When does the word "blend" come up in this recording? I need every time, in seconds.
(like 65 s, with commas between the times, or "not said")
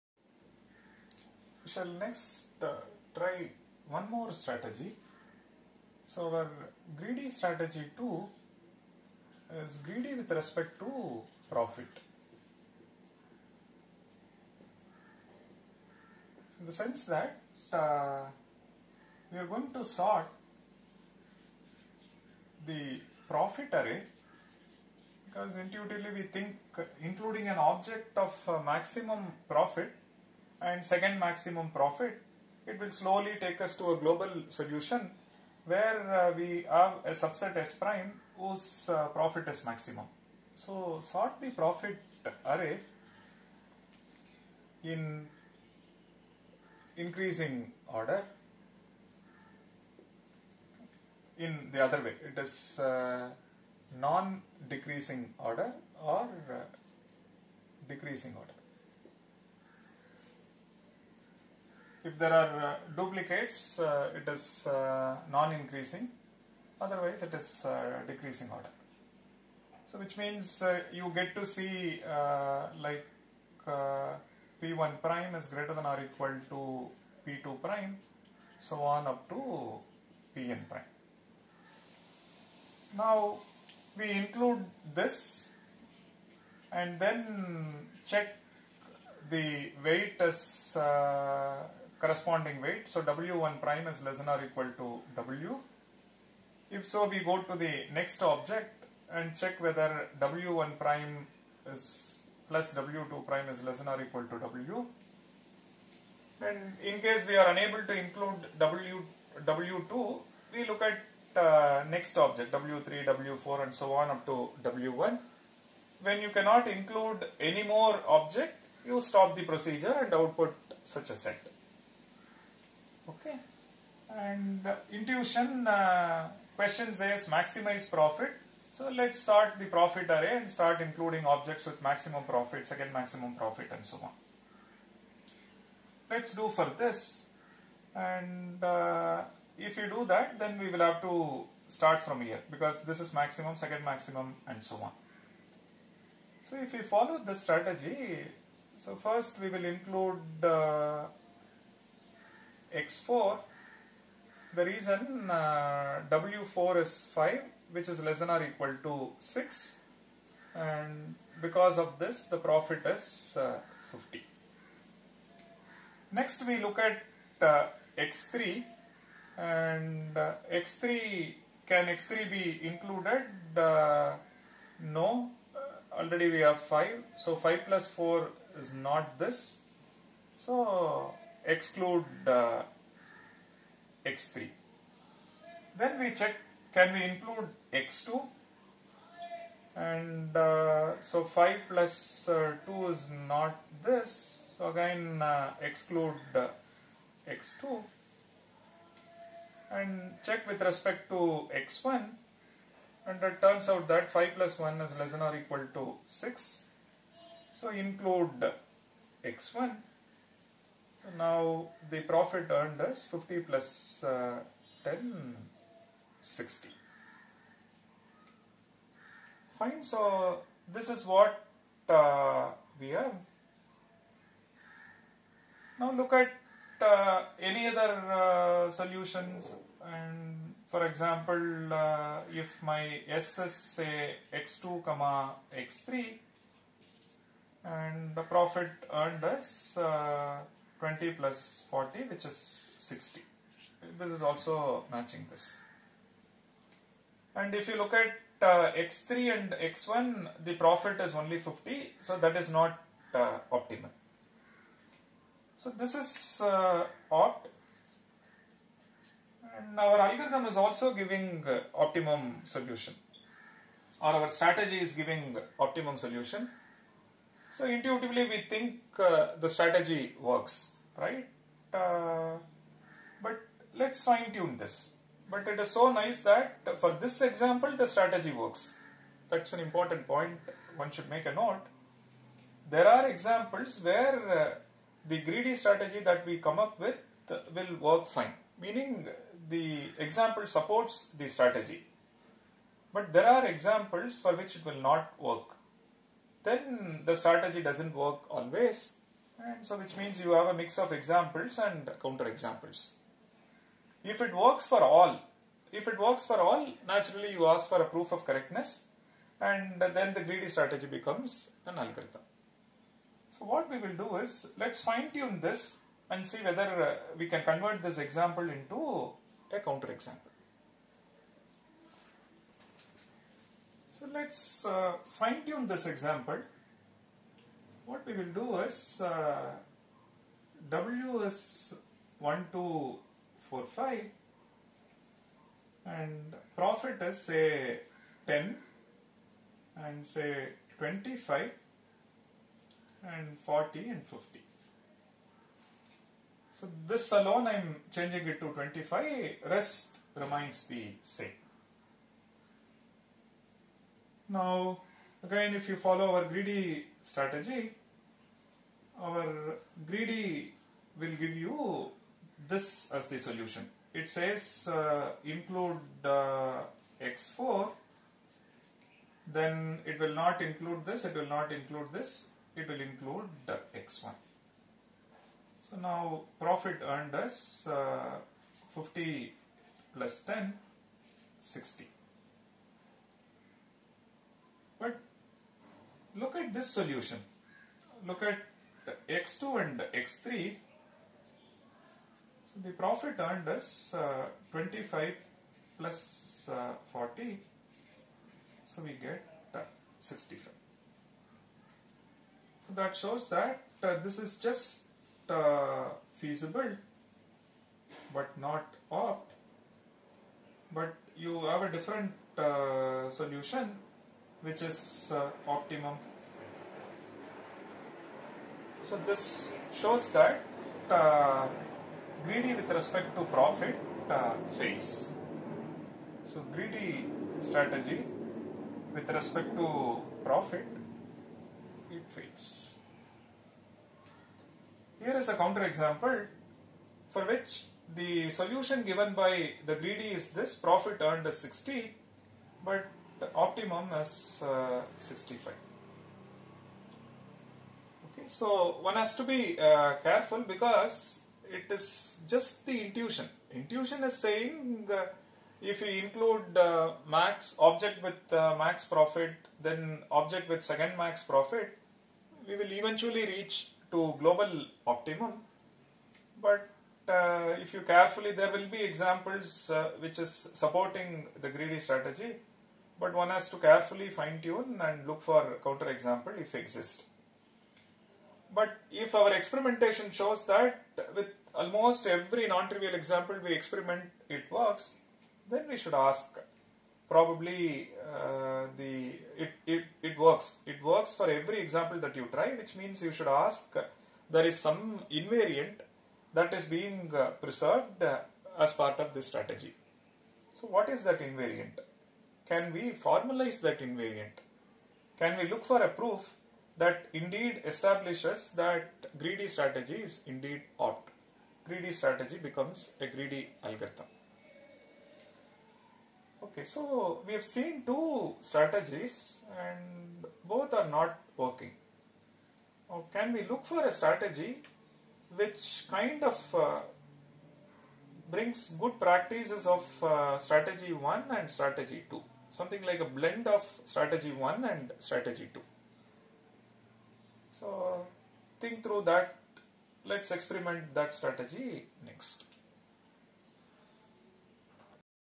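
533 s.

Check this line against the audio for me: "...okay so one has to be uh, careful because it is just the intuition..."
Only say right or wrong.
right.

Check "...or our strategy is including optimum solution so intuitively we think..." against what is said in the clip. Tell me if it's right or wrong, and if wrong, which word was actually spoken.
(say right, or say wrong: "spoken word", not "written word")
wrong: "giving", not "including".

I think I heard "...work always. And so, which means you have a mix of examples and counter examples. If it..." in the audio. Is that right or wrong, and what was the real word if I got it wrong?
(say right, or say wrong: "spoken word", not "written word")
right.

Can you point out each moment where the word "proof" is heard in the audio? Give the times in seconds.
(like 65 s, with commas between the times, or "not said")
307 s, 505 s.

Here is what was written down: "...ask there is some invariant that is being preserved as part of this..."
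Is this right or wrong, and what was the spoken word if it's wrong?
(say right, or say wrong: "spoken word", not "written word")
right.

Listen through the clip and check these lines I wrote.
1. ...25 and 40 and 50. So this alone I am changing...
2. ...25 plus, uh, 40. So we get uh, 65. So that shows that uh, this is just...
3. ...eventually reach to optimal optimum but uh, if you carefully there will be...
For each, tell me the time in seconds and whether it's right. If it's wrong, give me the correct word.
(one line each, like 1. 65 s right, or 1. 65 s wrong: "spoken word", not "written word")
1. 340 s right
2. 394 s right
3. 462 s wrong: "global", not "optimal".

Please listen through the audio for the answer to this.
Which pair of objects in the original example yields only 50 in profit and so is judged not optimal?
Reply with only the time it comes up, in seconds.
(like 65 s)
248 s.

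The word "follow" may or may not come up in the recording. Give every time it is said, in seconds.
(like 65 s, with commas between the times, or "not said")
146 s, 355 s.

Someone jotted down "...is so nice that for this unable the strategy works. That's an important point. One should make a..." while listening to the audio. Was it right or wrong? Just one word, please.
wrong.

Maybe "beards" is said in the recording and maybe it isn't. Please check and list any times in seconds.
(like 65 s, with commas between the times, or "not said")
not said.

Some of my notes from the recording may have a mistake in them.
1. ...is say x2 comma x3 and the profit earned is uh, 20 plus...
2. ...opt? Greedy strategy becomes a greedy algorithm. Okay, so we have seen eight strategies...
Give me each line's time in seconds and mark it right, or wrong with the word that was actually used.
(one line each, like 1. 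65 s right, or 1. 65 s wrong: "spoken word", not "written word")
1. 233 s right
2. 510 s wrong: "two", not "eight".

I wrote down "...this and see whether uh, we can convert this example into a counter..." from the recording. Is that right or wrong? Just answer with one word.
right.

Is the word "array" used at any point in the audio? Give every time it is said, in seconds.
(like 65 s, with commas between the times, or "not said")
23 s, 42 s, 130 s.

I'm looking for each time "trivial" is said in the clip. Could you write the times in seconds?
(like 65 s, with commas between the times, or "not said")
482 s.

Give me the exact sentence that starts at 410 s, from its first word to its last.
But you have a different uh, solution which is uh, optimum.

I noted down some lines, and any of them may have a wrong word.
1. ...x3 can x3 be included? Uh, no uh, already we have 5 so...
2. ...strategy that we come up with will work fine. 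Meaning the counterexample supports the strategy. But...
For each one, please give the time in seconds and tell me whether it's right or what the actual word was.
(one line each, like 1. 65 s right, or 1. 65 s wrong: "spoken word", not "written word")
1. 170 s right
2. 285 s wrong: "example", not "counterexample".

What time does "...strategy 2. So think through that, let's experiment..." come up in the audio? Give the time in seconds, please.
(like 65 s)
534 s.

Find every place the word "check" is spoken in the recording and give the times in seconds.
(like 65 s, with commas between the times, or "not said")
88 s, 99 s, 186 s, 200 s.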